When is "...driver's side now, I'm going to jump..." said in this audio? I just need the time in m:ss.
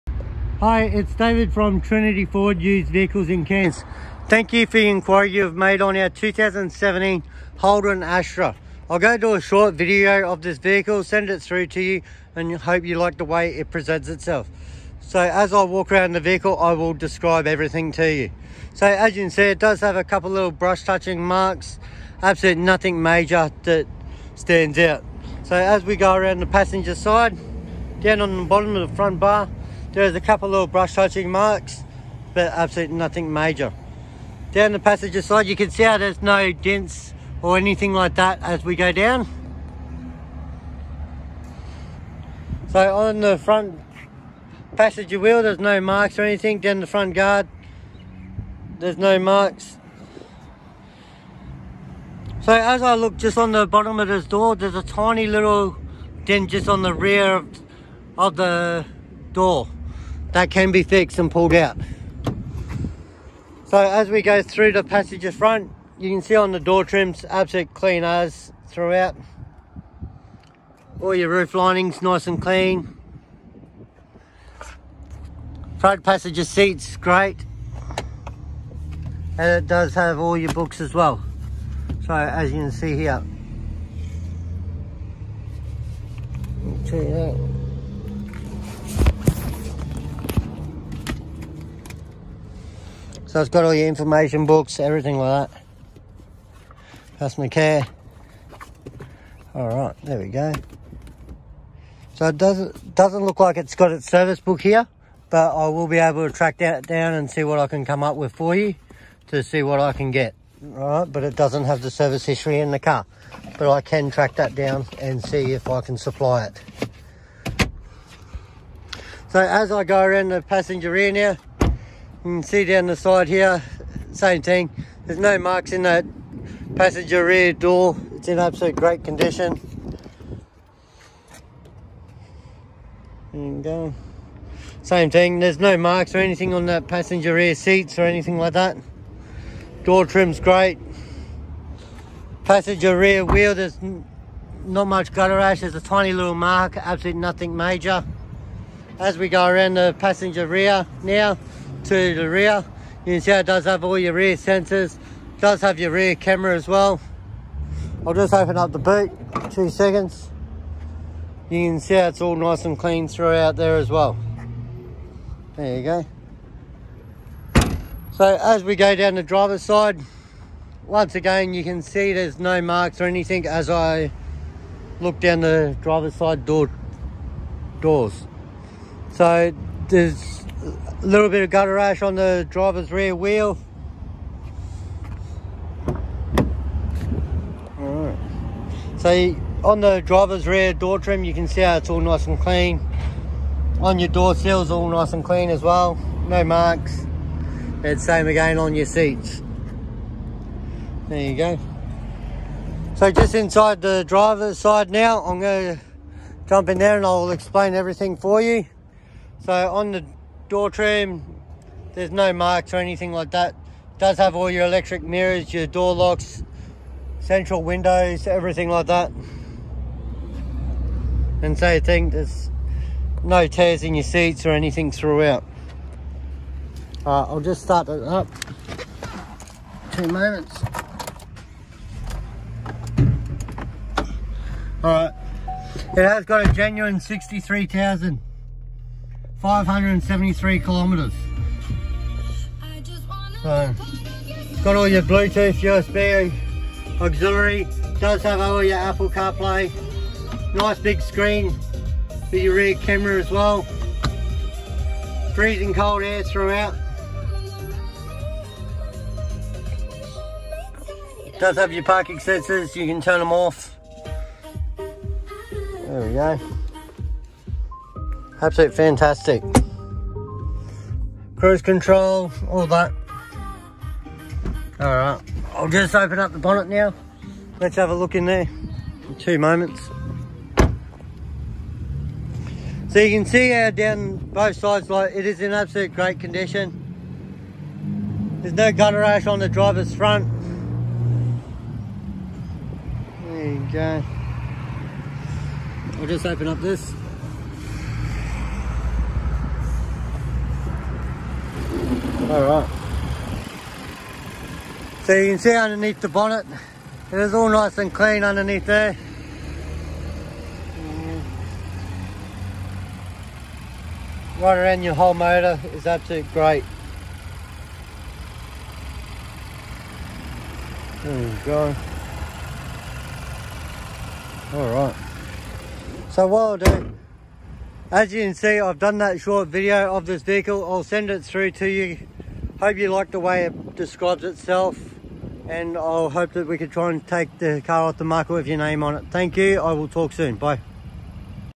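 3:24.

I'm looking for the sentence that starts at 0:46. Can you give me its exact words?
Down the front guard, there's no marks.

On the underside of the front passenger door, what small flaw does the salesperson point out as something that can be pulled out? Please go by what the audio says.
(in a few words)
tiny little dent.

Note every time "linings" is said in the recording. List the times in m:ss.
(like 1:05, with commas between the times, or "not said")
1:11.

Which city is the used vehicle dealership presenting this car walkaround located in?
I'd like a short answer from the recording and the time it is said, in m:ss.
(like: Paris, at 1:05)
Cairns, at 0:03.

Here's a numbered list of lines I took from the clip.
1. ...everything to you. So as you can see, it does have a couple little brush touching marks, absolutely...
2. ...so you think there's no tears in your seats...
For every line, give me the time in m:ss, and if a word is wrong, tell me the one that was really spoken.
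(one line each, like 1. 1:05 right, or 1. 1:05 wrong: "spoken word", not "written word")
1. 0:17 right
2. 3:41 right.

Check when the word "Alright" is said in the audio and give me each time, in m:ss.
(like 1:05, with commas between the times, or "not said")
3:07, 5:02, 5:24.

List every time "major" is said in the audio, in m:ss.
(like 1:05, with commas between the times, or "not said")
0:23, 0:33, 2:27.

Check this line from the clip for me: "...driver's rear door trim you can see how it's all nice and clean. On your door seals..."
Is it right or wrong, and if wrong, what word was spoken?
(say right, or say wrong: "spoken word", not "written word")
right.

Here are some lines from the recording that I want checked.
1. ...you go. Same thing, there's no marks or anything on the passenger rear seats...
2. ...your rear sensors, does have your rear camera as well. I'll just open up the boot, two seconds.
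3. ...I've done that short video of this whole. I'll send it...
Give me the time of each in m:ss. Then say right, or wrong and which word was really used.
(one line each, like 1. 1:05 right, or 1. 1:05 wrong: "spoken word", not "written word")
1. 2:13 right
2. 2:33 right
3. 5:28 wrong: "vehicle", not "whole".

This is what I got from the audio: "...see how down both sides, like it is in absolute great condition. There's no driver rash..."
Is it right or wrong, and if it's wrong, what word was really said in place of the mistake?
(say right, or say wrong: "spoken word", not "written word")
wrong: "gutter", not "driver".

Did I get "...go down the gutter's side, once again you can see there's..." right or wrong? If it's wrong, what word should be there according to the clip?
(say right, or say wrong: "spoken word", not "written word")
wrong: "driver", not "gutter".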